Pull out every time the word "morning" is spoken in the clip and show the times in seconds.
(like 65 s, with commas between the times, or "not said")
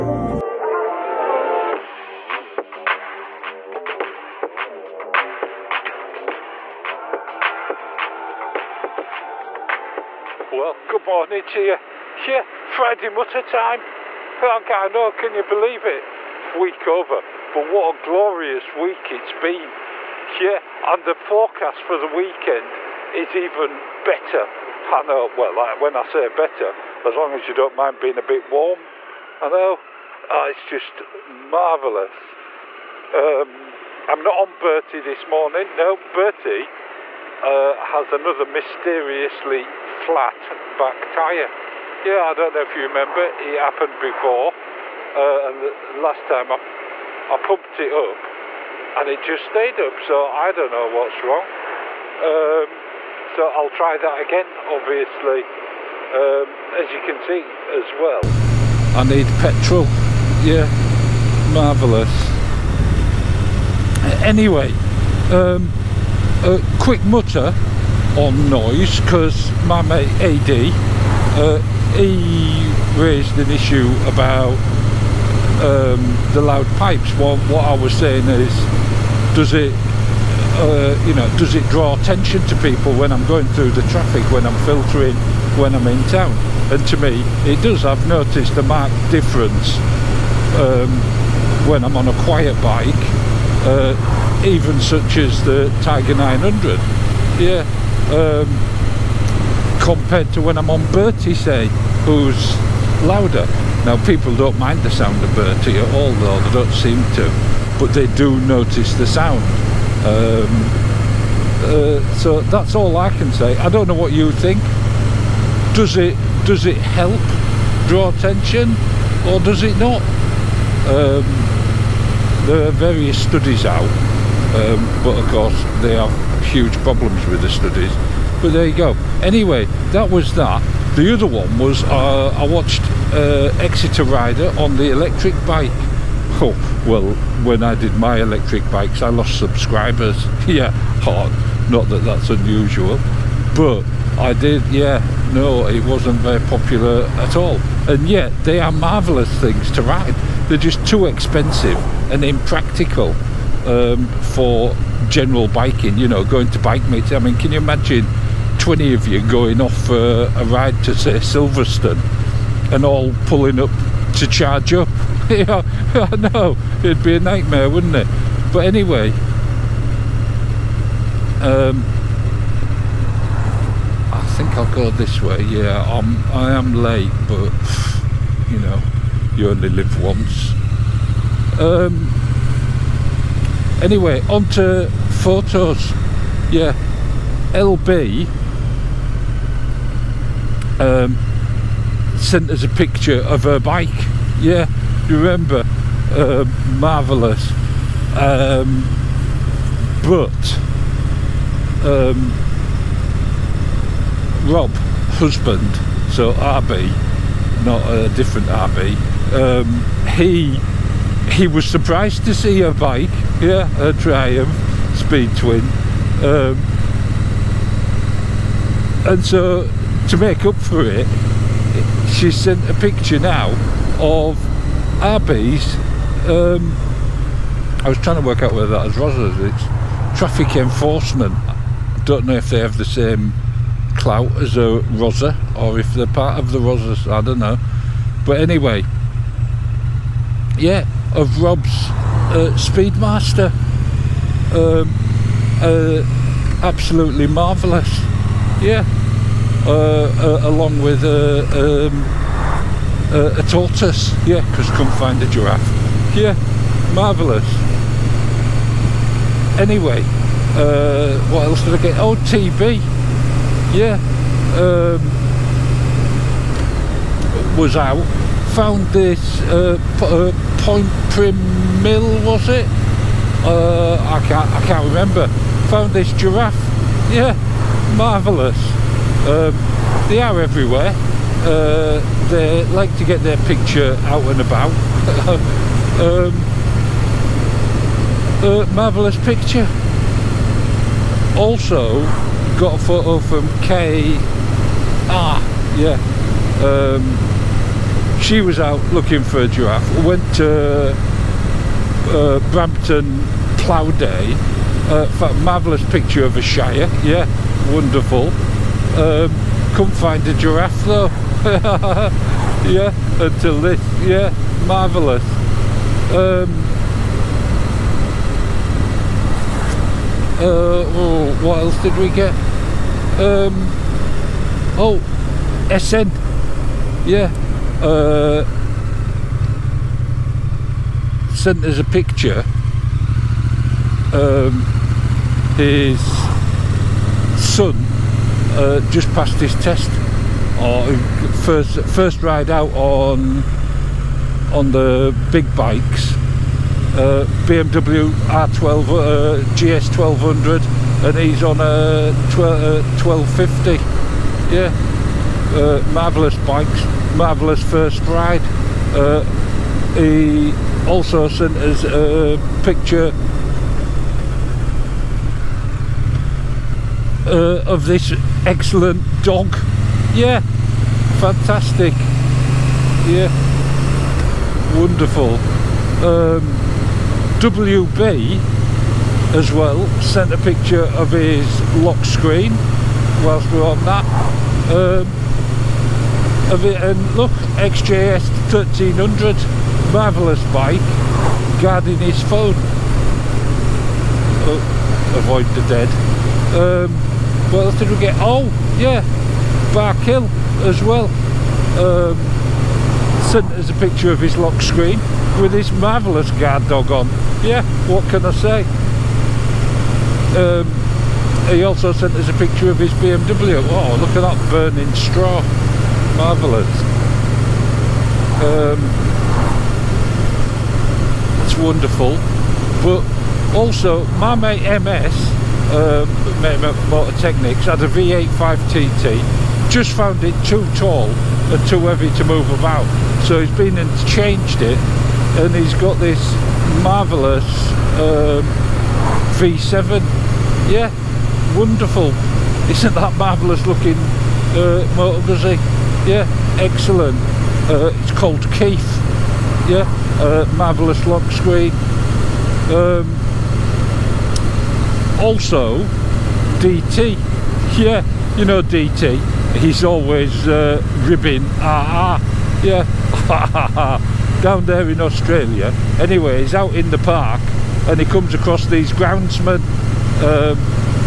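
11 s, 35 s.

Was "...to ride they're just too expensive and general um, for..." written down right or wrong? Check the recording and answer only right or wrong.
wrong.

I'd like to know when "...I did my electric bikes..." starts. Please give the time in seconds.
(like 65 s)
137 s.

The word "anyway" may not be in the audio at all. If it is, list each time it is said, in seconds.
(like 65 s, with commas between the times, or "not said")
64 s, 129 s, 168 s, 183 s, 238 s, 259 s, 465 s.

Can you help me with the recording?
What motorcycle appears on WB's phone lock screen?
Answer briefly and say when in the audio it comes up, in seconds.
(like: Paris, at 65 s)
XJS 1300, at 387 s.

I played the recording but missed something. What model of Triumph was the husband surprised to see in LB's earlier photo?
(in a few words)
Speed Twin.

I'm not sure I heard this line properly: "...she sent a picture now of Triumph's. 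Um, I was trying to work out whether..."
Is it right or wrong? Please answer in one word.
wrong.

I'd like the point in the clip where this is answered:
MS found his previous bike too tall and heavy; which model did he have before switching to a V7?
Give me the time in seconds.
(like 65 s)
427 s.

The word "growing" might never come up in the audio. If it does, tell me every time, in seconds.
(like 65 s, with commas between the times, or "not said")
not said.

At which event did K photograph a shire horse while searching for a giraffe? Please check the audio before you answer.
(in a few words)
Brampton Plough Day.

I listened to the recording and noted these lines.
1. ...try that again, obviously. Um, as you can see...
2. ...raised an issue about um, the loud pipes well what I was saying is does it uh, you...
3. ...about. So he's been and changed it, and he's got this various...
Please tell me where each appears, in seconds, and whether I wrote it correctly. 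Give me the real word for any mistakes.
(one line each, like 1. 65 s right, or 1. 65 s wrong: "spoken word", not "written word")
1. 53 s right
2. 73 s right
3. 432 s wrong: "marvellous", not "various".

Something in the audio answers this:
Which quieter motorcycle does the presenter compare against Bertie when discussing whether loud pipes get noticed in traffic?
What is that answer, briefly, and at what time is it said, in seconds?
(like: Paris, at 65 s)
Tiger 900, at 95 s.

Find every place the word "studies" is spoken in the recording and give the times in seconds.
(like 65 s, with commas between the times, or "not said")
123 s, 127 s.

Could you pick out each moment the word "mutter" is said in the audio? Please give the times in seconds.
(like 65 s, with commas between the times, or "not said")
13 s, 67 s.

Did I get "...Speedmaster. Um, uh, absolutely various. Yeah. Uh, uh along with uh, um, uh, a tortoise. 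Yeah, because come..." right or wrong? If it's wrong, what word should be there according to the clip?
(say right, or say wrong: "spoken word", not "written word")
wrong: "marvellous", not "various".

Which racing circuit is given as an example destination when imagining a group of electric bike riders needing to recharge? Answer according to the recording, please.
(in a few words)
Silverstone.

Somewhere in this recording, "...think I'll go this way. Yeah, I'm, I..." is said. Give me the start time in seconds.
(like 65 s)
174 s.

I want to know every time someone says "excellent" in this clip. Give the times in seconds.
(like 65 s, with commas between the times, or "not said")
368 s, 446 s.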